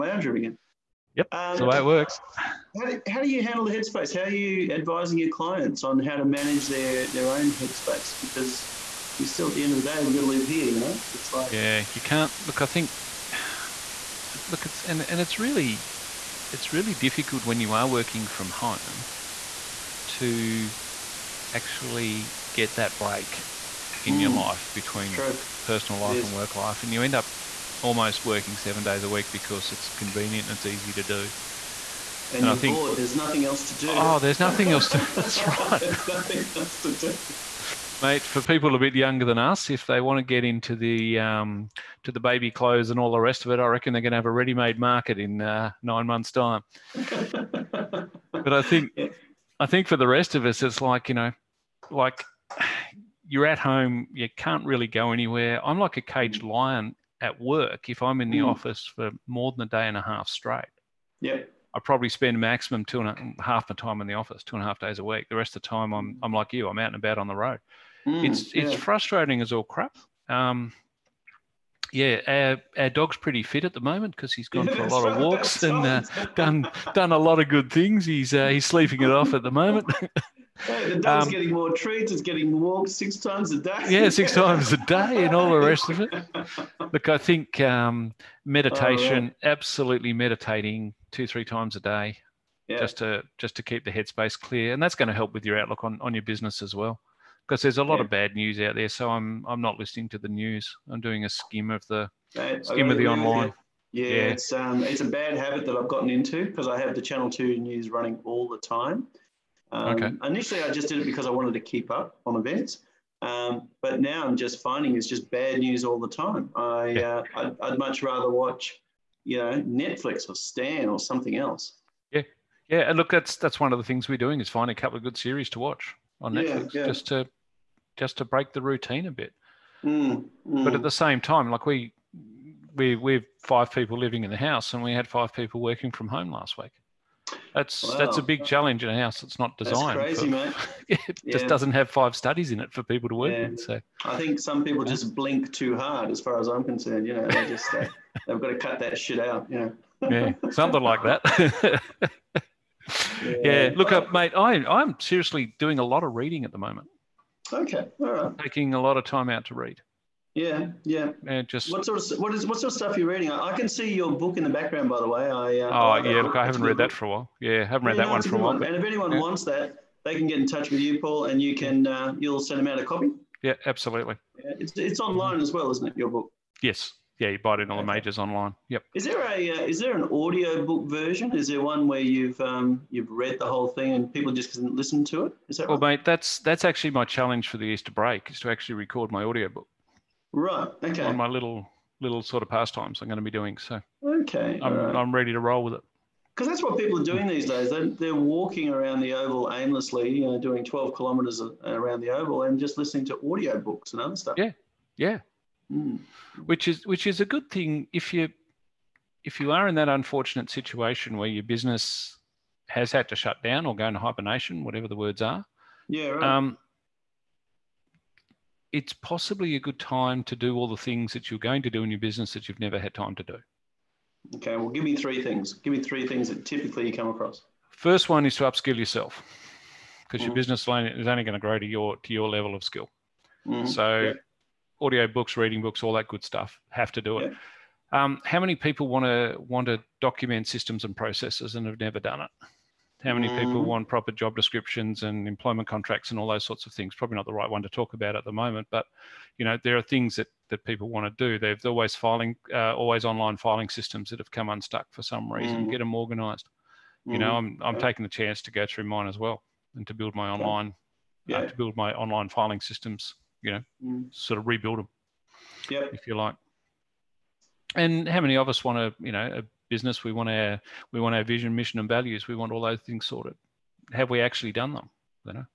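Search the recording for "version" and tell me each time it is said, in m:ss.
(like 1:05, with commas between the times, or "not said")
3:00.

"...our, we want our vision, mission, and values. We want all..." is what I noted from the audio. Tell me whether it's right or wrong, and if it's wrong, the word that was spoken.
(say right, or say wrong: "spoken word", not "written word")
right.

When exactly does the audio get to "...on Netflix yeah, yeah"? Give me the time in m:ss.
2:06.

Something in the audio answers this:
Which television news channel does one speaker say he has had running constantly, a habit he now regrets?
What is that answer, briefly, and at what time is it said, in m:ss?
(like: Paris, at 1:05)
Channel 2, at 1:47.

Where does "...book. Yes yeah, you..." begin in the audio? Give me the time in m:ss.
2:56.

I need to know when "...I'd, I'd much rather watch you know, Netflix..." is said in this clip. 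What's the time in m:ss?
1:57.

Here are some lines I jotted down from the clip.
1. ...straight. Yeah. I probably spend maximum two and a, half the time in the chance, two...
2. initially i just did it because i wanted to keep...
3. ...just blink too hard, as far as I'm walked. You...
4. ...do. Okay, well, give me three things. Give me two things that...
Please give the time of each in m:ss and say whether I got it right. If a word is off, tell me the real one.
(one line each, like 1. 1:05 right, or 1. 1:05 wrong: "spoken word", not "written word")
1. 1:00 wrong: "office", not "chance"
2. 1:50 right
3. 2:24 wrong: "concerned", not "walked"
4. 3:43 wrong: "three", not "two".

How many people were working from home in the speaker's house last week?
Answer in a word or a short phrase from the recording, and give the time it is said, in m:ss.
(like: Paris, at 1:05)
5, at 2:15.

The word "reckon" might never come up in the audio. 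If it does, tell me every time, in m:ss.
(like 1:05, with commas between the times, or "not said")
0:43.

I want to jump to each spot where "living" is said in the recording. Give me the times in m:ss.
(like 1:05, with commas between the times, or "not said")
2:13.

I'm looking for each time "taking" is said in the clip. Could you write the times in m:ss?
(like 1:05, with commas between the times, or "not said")
2:38, 4:17.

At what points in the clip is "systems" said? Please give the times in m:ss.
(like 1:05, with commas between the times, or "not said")
4:00, 4:13, 4:22.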